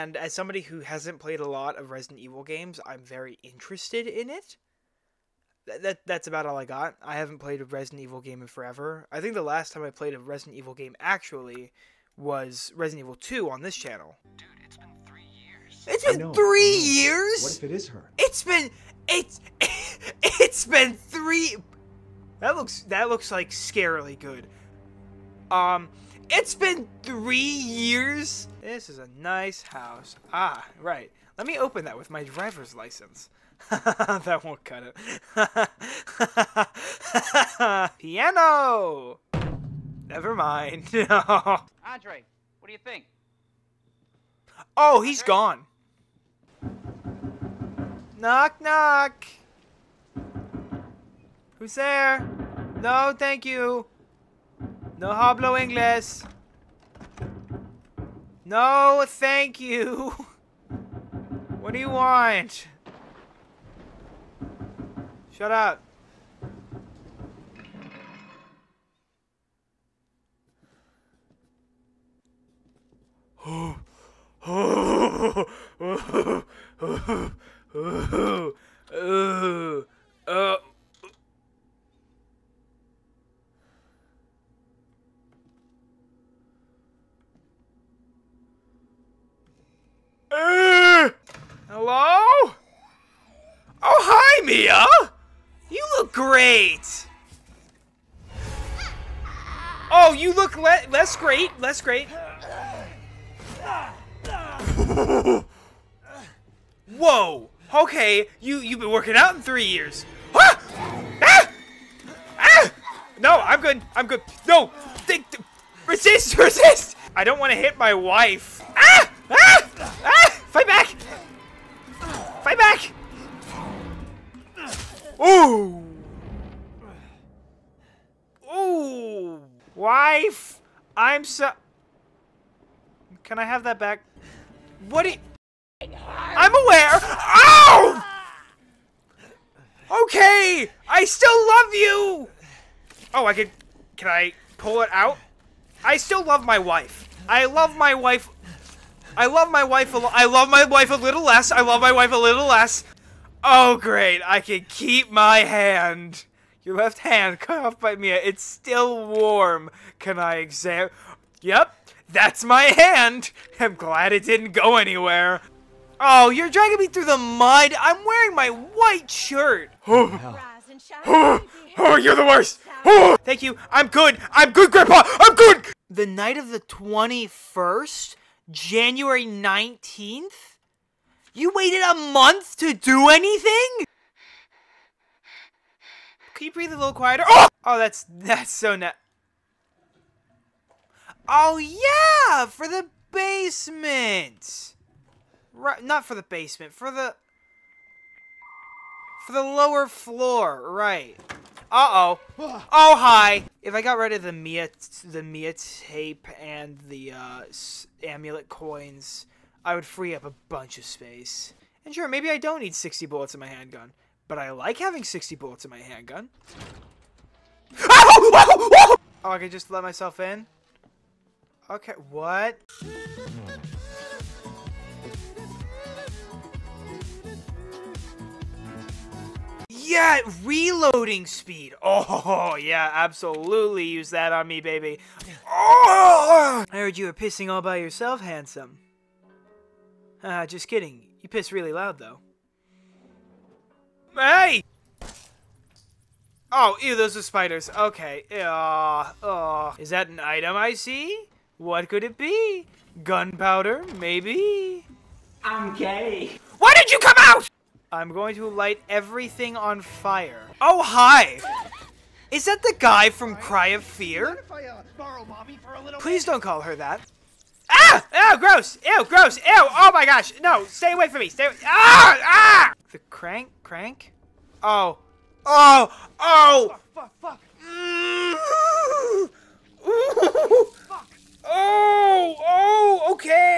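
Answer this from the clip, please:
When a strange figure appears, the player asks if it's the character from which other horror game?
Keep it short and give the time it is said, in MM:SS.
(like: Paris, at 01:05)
Cry of Fear, at 04:23.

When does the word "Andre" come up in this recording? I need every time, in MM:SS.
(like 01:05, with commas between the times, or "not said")
00:40, 00:45.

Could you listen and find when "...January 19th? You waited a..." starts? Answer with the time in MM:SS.
02:58.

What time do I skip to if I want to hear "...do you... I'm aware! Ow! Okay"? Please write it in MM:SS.
02:15.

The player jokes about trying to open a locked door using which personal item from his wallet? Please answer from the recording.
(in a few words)
driver's license.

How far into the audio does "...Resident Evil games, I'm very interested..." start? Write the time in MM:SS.
00:01.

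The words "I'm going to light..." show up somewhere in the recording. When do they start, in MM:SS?
04:17.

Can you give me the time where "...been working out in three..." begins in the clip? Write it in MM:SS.
01:48.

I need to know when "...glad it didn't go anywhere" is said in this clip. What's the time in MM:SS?
02:43.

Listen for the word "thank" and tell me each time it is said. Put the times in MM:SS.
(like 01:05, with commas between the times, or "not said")
00:53, 00:59, 02:53.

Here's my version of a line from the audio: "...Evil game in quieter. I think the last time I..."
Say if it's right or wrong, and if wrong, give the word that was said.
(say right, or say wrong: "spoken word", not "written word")
wrong: "forever", not "quieter".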